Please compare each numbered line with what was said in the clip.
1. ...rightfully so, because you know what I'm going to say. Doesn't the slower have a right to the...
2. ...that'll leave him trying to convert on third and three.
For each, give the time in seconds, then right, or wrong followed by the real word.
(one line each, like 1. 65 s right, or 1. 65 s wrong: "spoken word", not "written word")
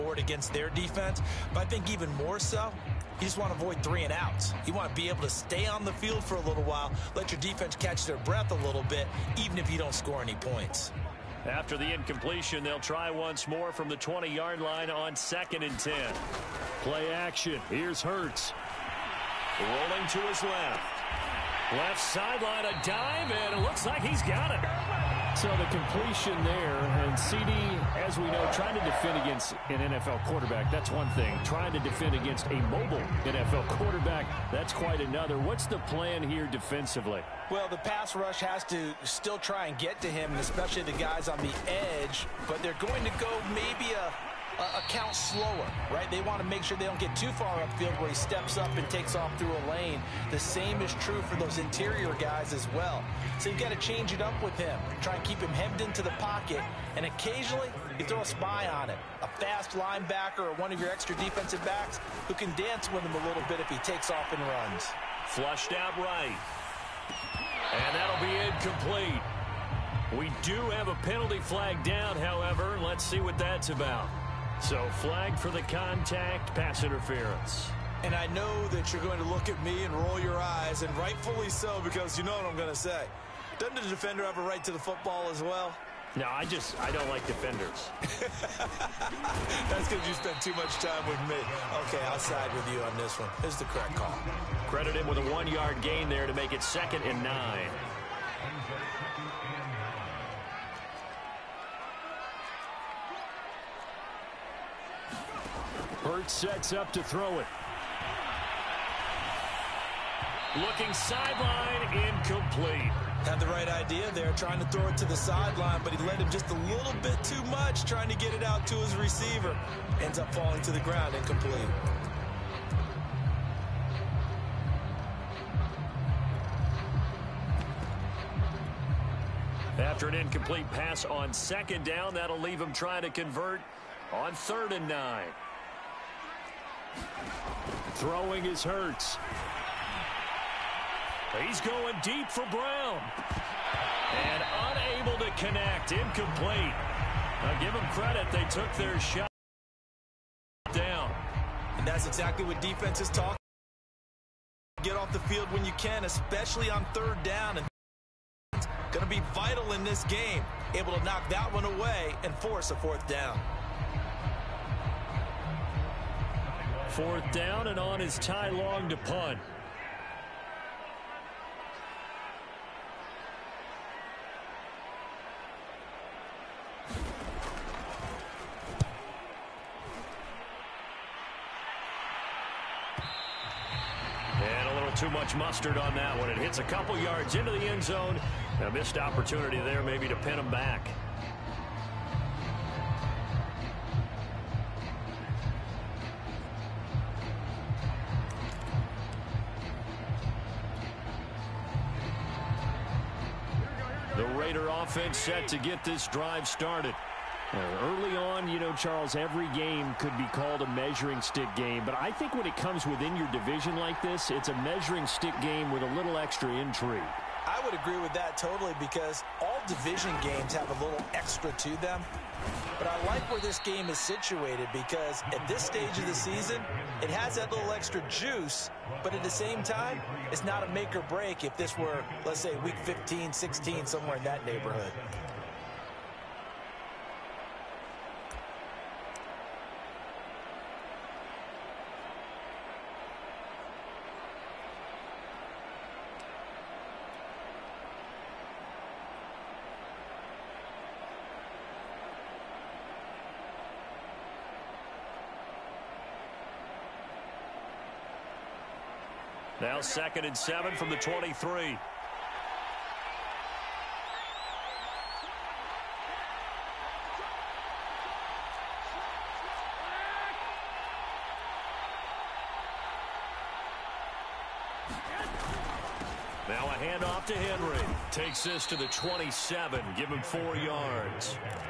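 1. 80 s wrong: "defender", not "slower"
2. 132 s wrong: "nine", not "three".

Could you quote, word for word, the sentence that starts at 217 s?
I would agree with that totally because all division games have a little extra to them.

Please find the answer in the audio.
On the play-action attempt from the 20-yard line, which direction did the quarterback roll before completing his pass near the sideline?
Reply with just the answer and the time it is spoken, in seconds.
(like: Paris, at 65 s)
Left, at 19 s.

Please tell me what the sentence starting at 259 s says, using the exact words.
Now second and seven from the 23.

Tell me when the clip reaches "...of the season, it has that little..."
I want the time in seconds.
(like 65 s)
225 s.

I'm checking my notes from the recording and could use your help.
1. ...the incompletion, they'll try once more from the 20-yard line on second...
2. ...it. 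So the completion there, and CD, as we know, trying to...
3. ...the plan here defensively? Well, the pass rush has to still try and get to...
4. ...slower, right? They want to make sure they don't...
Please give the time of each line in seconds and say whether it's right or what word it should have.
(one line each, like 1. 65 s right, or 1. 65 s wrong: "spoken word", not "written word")
1. 11 s right
2. 24 s right
3. 35 s right
4. 45 s right.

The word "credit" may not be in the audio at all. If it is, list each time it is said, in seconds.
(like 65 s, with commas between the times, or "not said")
94 s, 147 s.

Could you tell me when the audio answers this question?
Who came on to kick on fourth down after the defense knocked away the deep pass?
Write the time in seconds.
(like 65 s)
168 s.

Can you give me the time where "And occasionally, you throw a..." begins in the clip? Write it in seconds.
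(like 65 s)
56 s.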